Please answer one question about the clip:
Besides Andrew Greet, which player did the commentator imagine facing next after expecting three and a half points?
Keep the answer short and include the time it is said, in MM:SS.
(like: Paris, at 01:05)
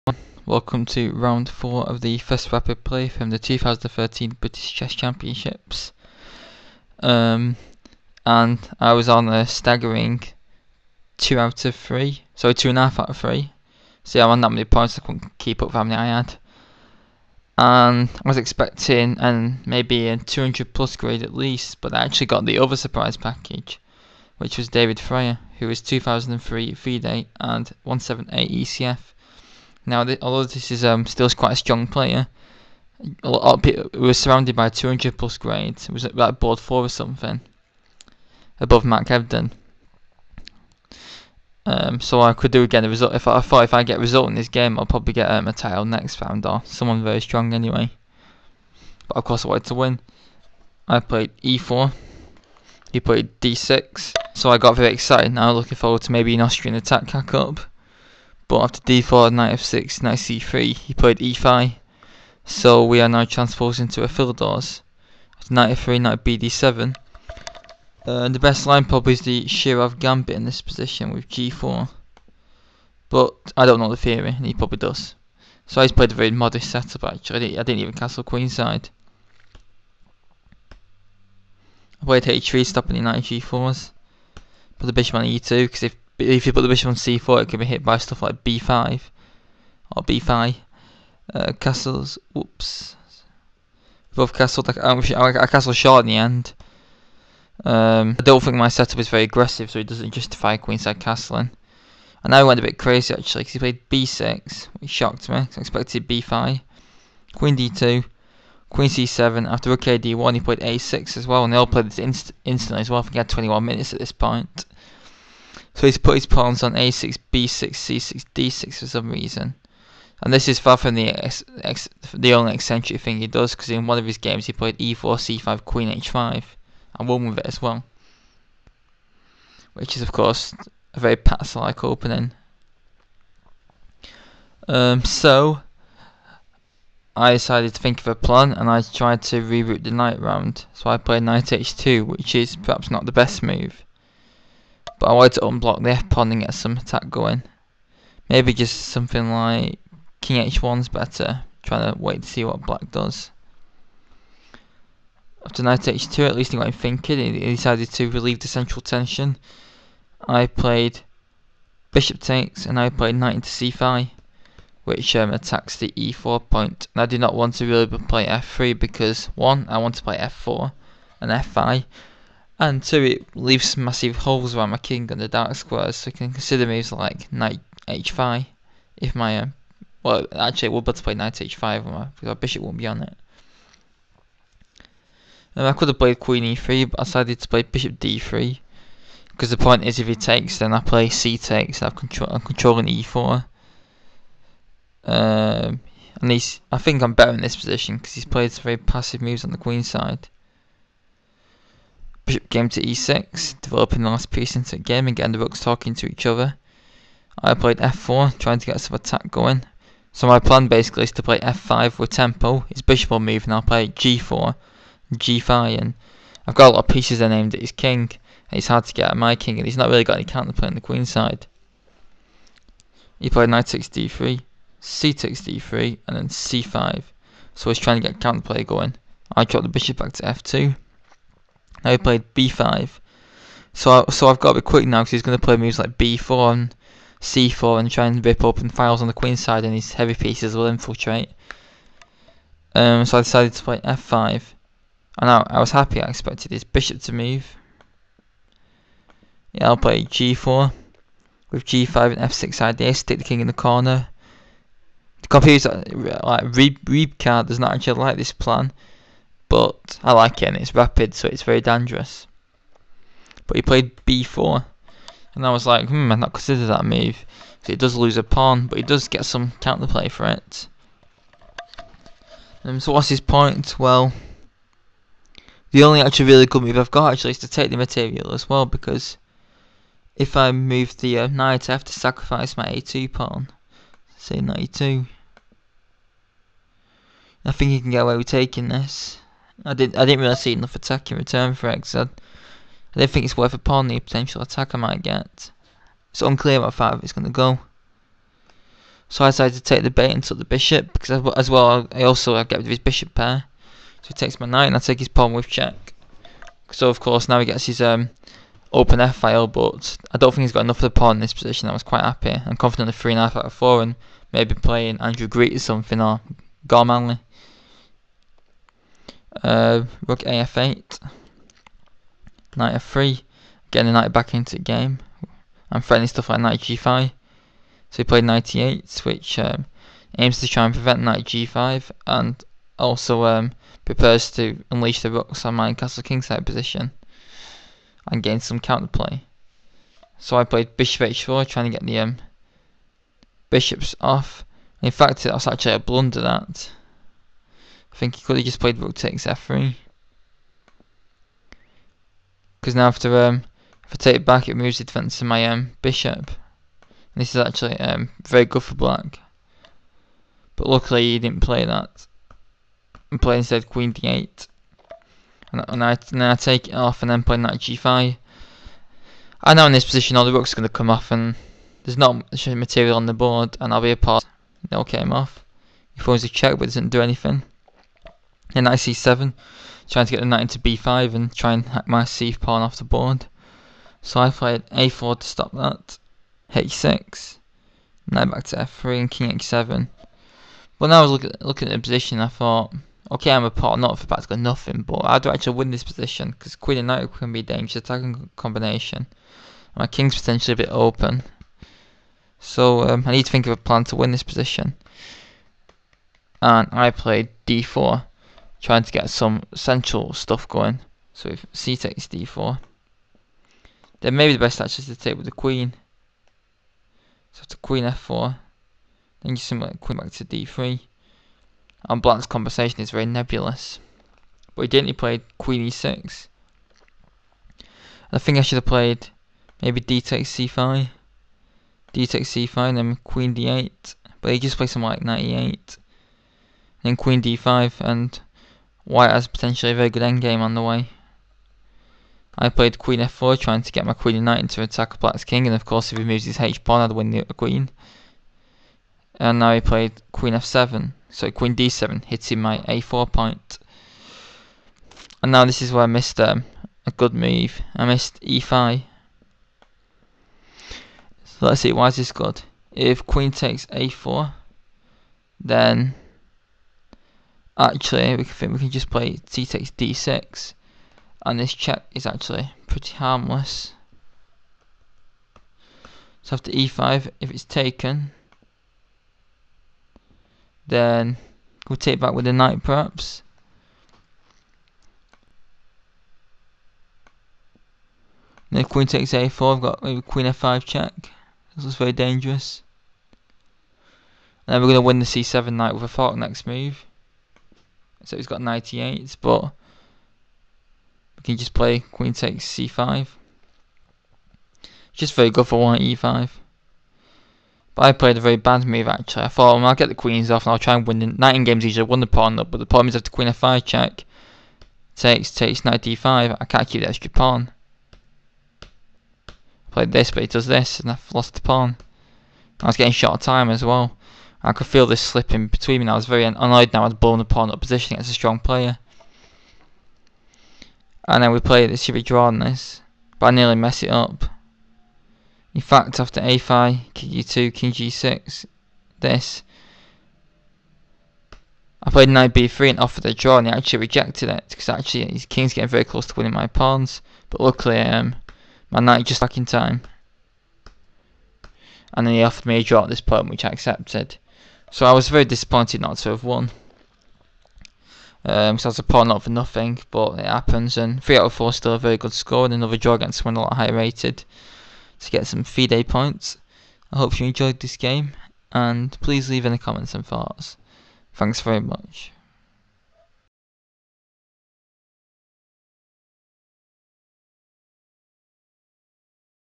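Gormally, at 05:16.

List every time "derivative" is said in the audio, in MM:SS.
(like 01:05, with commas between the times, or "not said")
not said.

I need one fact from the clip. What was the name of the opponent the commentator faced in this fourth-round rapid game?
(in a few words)
David Fryer.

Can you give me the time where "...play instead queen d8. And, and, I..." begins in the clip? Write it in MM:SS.
06:03.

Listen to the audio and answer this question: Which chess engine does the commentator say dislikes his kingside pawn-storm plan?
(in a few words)
Rybka.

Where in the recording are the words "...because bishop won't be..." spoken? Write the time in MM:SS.
03:02.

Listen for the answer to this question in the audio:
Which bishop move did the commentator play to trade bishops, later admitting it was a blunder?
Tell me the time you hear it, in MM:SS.
05:40.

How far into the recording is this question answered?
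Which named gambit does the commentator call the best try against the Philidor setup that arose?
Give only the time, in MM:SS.
01:09.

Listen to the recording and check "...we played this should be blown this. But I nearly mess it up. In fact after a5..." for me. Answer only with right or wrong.
wrong.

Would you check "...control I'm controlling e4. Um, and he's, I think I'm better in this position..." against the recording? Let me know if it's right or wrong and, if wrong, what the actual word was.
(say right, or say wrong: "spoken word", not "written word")
right.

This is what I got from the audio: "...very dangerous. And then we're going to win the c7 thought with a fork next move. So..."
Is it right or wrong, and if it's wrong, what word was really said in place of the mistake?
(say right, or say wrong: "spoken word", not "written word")
wrong: "knight", not "thought".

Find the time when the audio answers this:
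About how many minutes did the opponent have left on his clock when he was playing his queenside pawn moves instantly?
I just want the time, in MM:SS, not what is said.
01:53.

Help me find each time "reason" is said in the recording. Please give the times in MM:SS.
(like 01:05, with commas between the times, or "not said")
01:59.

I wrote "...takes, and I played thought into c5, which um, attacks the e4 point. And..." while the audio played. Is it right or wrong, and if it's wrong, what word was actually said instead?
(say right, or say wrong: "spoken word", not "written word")
wrong: "knight", not "thought".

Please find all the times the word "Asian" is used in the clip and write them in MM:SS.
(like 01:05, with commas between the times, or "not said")
not said.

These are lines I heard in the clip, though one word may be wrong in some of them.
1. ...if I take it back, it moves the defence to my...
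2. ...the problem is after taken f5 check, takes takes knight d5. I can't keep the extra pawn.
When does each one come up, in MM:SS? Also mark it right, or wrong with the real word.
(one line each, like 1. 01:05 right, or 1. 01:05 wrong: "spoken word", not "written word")
1. 05:53 right
2. 08:32 wrong: "queen", not "taken".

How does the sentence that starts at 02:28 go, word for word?
Maybe just something like king h1's better, trying to wait to see what black does.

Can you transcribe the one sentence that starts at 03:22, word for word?
Bishop came to e6, developing the last piece into a game and getting the rooks talking to each other.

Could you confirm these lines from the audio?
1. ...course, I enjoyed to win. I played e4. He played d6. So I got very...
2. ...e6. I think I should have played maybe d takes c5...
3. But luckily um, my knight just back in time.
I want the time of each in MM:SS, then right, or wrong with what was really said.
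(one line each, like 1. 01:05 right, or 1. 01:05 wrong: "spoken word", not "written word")
1. 00:49 wrong: "wanted", not "enjoyed"
2. 07:05 right
3. 09:07 right.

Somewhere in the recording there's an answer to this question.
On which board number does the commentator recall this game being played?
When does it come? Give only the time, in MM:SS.
00:36.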